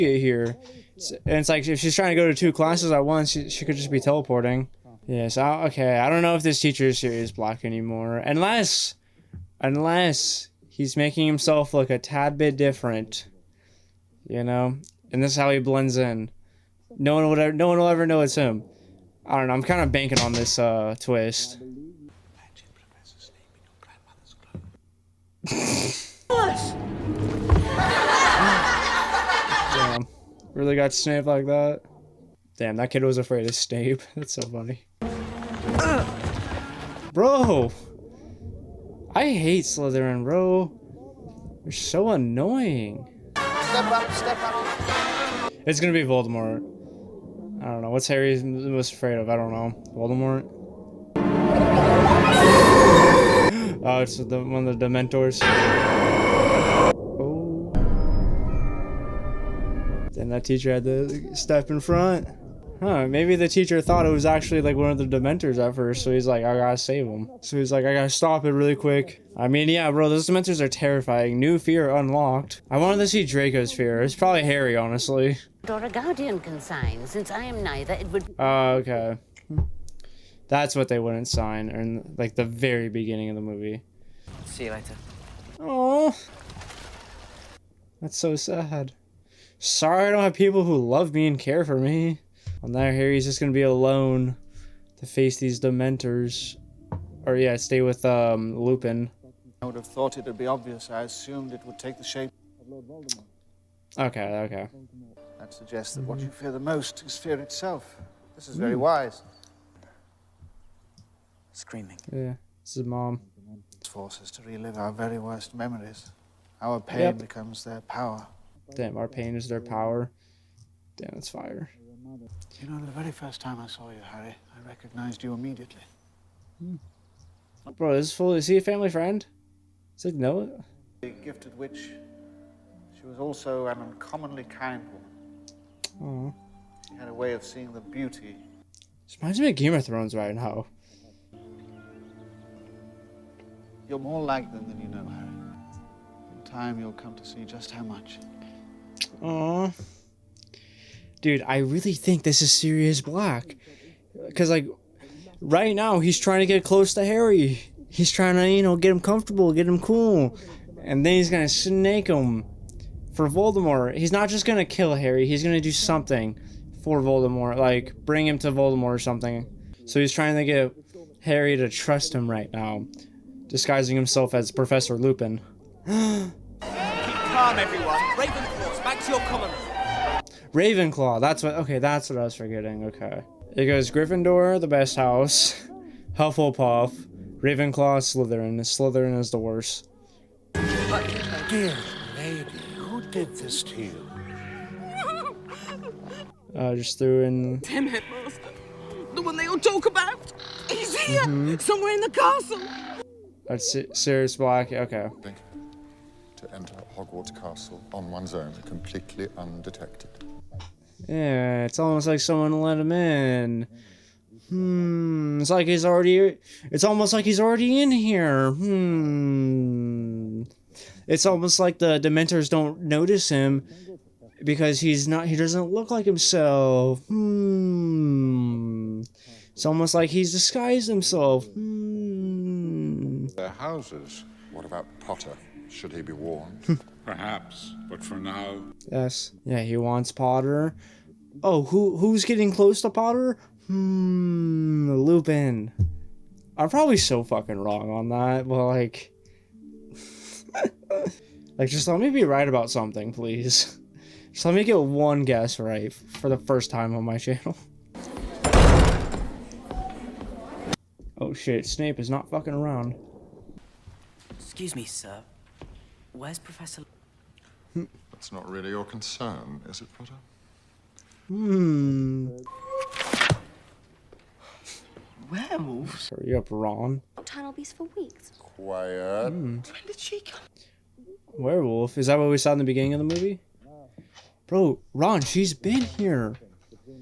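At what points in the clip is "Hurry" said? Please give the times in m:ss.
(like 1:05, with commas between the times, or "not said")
4:36.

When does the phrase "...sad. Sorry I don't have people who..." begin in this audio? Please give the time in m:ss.
1:28.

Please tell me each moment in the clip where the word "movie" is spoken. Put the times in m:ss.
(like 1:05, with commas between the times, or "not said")
1:23, 4:43.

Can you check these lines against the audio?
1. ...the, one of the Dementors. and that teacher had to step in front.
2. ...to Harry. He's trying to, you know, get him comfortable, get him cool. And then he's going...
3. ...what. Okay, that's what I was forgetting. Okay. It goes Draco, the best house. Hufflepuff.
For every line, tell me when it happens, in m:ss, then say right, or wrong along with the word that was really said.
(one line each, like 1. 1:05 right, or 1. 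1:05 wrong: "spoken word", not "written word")
1. 0:54 right
2. 2:36 right
3. 3:01 wrong: "Gryffindor", not "Draco".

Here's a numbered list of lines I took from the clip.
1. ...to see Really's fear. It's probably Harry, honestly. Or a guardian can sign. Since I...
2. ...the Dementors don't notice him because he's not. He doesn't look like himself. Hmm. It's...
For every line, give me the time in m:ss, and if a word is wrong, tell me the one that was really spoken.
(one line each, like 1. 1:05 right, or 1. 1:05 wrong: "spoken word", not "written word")
1. 1:12 wrong: "Draco", not "Really"
2. 3:41 right.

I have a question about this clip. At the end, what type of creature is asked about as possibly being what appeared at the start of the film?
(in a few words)
Werewolf.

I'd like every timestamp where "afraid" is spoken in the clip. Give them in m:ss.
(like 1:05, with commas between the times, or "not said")
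0:33, 0:48.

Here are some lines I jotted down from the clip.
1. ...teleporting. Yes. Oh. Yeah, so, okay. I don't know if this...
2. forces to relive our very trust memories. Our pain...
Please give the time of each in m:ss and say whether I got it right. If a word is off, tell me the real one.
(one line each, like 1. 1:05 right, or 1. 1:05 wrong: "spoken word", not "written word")
1. 0:03 right
2. 1:53 wrong: "worst", not "trust".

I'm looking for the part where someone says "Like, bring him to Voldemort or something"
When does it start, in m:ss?
2:47.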